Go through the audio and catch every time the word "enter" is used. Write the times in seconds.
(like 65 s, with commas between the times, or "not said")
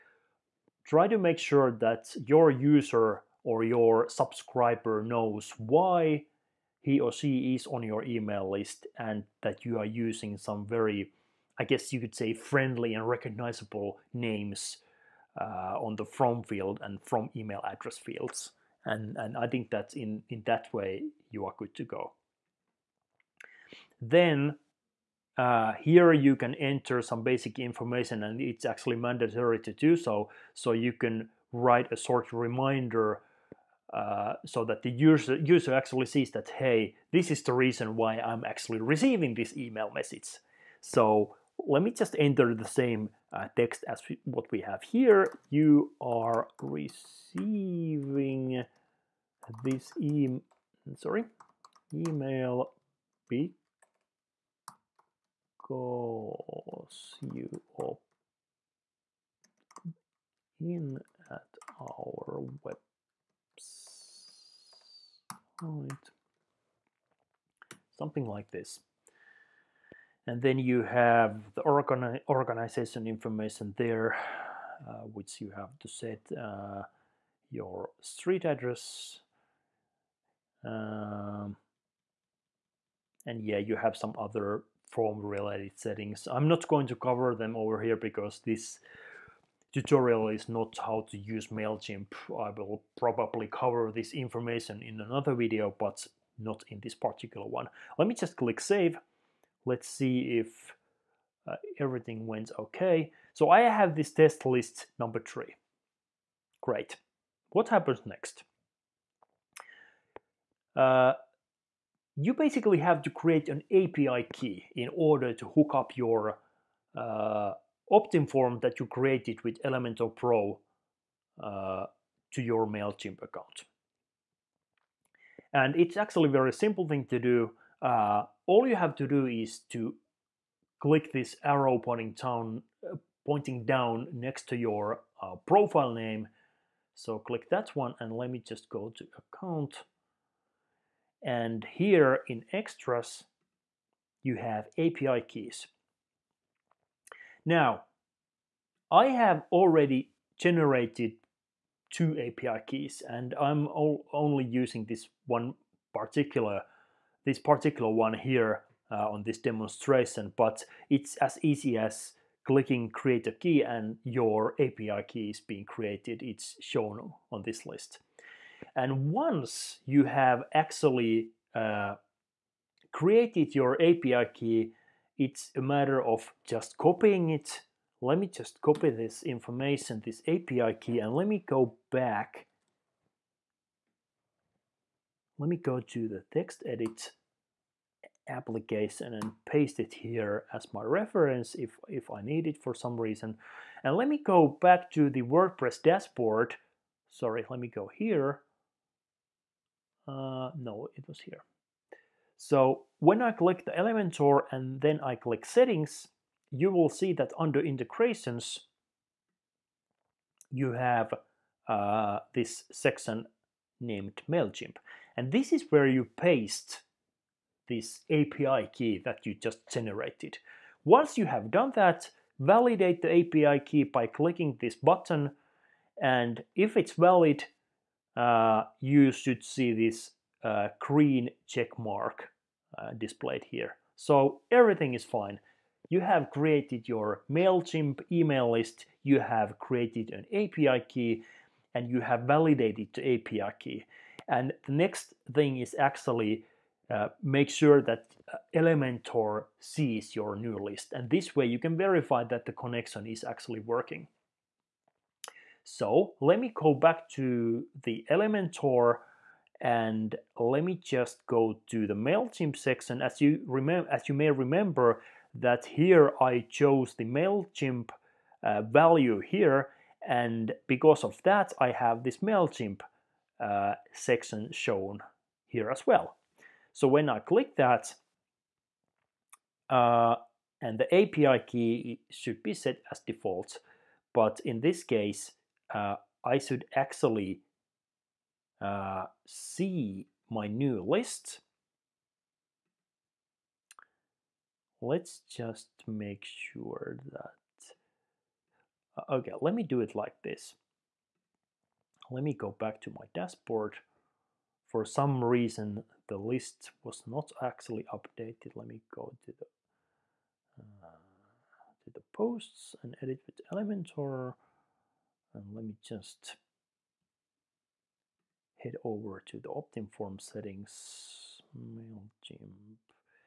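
26 s, 42 s.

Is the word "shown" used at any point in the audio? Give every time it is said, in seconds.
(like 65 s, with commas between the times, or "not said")
166 s, 274 s.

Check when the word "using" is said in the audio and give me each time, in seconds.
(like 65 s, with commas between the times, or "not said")
9 s, 154 s.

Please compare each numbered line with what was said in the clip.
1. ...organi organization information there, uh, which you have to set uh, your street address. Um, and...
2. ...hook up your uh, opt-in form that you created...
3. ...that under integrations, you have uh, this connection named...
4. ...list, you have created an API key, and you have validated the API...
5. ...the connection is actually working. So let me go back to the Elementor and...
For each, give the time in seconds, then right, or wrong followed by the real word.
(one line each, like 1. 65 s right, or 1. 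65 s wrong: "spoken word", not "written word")
1. 71 s right
2. 115 s right
3. 207 s wrong: "section", not "connection"
4. 238 s right
5. 252 s right.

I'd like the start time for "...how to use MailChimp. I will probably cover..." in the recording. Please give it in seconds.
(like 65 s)
90 s.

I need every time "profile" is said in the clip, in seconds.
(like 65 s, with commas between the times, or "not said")
135 s.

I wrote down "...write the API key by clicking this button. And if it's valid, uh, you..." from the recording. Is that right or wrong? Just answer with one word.
wrong.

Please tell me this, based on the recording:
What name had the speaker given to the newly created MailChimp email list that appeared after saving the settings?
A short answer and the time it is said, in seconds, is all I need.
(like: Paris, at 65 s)
test list number three, at 104 s.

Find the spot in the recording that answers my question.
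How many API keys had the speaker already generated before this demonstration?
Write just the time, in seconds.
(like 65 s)
151 s.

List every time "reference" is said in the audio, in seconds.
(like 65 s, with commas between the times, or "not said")
190 s.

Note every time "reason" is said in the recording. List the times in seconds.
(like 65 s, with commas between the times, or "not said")
37 s, 192 s, 305 s.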